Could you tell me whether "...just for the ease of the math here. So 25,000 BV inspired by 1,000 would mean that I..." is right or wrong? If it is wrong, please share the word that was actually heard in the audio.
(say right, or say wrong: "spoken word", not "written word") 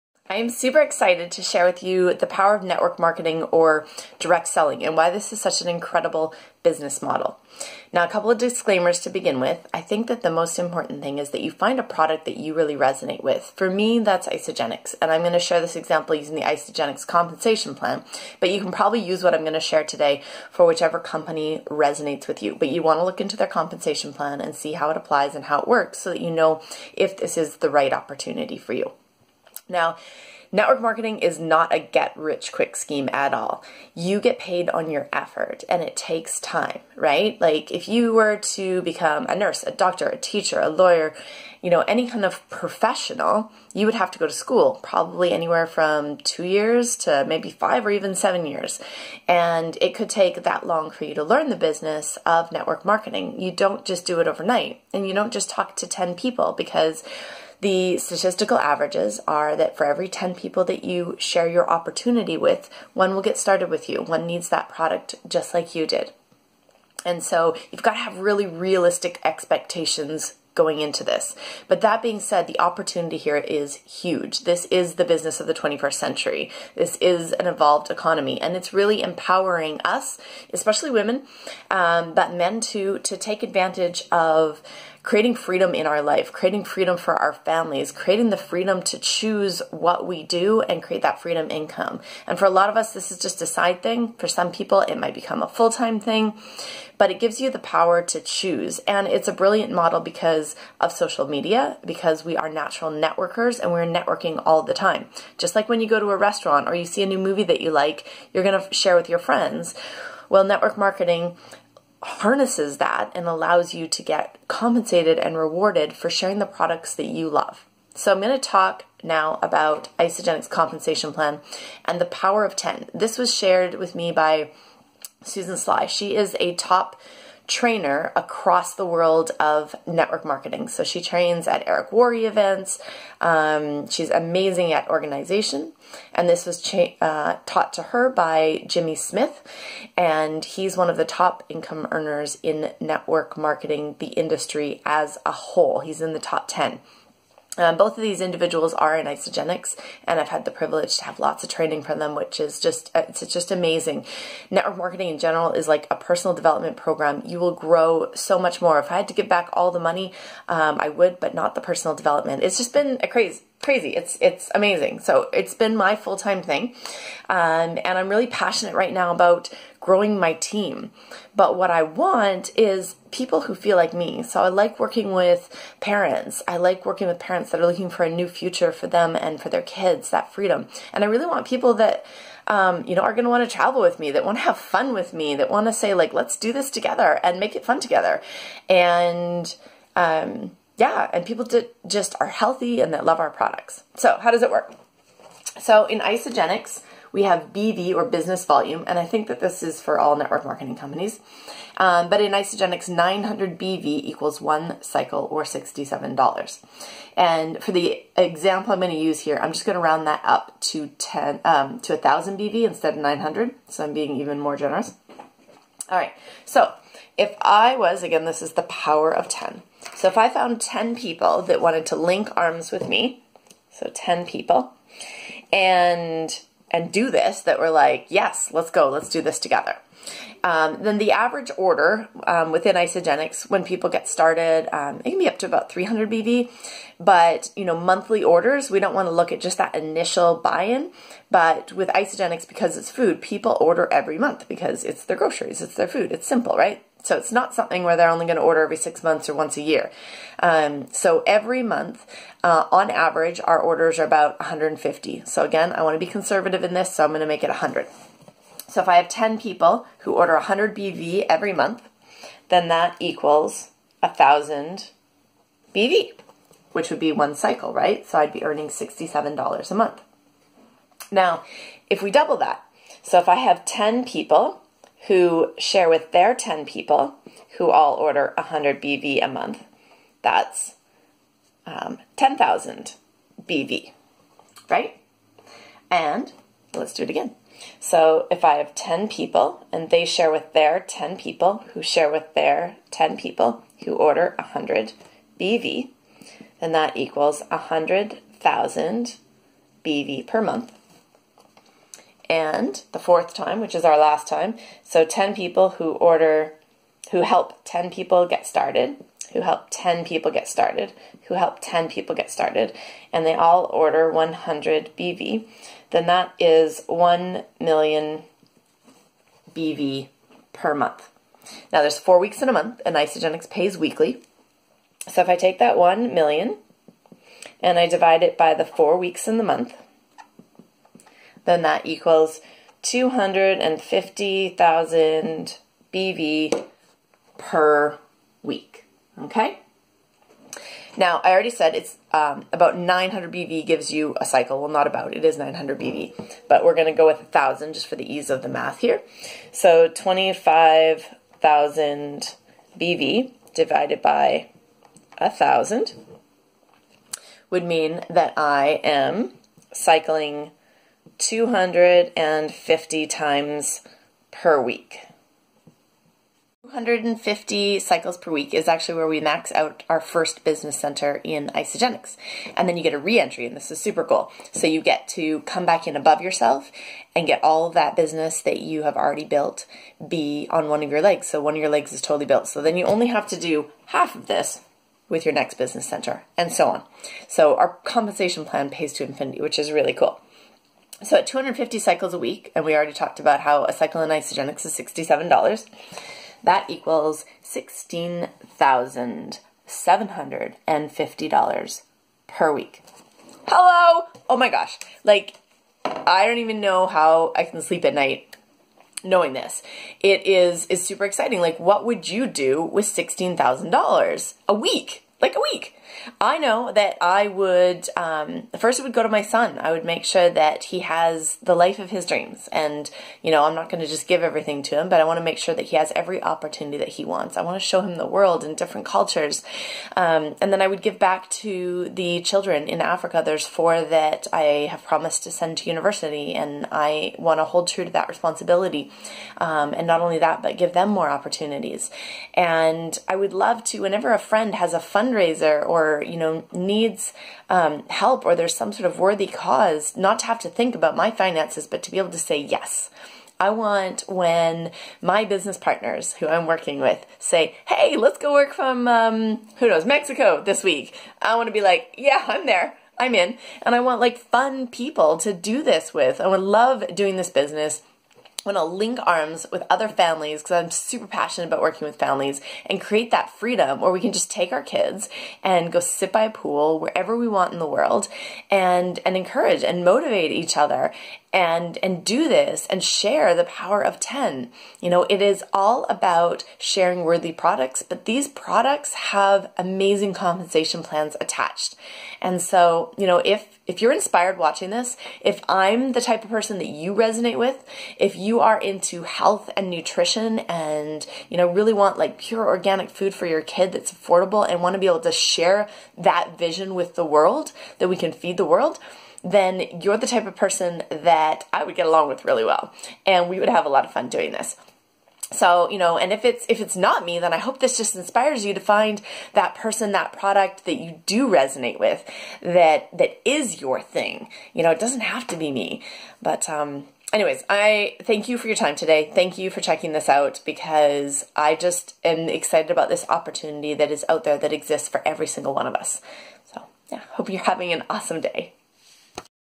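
wrong: "divided", not "inspired".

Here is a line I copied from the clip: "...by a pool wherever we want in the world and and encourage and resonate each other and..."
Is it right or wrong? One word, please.
wrong.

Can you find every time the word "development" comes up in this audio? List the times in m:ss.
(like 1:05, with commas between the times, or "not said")
2:36, 2:41.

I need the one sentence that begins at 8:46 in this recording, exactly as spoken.
But um anyways, I thank you for your time today.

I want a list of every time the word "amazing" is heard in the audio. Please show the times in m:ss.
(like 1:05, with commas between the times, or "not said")
2:14, 2:33, 2:44, 8:09.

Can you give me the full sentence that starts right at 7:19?
Um, and not only that, but give them more opportunities.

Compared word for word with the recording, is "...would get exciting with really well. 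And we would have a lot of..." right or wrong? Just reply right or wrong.
wrong.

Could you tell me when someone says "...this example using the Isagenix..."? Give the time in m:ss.
0:15.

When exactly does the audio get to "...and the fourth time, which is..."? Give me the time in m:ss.
5:02.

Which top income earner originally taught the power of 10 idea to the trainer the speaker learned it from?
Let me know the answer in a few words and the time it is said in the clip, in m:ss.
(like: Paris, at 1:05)
Jimmy Smith, at 2:18.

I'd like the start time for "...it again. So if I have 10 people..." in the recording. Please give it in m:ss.
4:47.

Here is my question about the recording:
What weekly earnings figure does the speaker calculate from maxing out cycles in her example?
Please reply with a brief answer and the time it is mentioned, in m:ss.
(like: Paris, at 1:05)
$16,750, at 6:37.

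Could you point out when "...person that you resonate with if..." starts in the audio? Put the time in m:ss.
8:16.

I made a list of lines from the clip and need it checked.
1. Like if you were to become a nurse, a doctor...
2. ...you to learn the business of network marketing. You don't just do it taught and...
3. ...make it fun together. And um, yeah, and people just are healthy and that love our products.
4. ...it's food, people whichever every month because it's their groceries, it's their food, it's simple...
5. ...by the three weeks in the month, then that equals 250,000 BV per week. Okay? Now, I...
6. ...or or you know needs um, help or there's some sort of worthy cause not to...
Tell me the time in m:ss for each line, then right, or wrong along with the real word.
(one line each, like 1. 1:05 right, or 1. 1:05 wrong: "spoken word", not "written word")
1. 0:37 right
2. 0:51 wrong: "overnight", not "taught"
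3. 3:07 right
4. 4:02 wrong: "order", not "whichever"
5. 5:28 wrong: "four", not "three"
6. 7:25 right.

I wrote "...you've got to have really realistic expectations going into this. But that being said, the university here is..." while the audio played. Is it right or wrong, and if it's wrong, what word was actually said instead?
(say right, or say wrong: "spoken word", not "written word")
wrong: "opportunity", not "university".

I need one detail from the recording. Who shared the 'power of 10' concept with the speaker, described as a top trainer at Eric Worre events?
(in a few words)
Susan Sly.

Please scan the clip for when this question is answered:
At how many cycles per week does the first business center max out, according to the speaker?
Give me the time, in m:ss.
6:06.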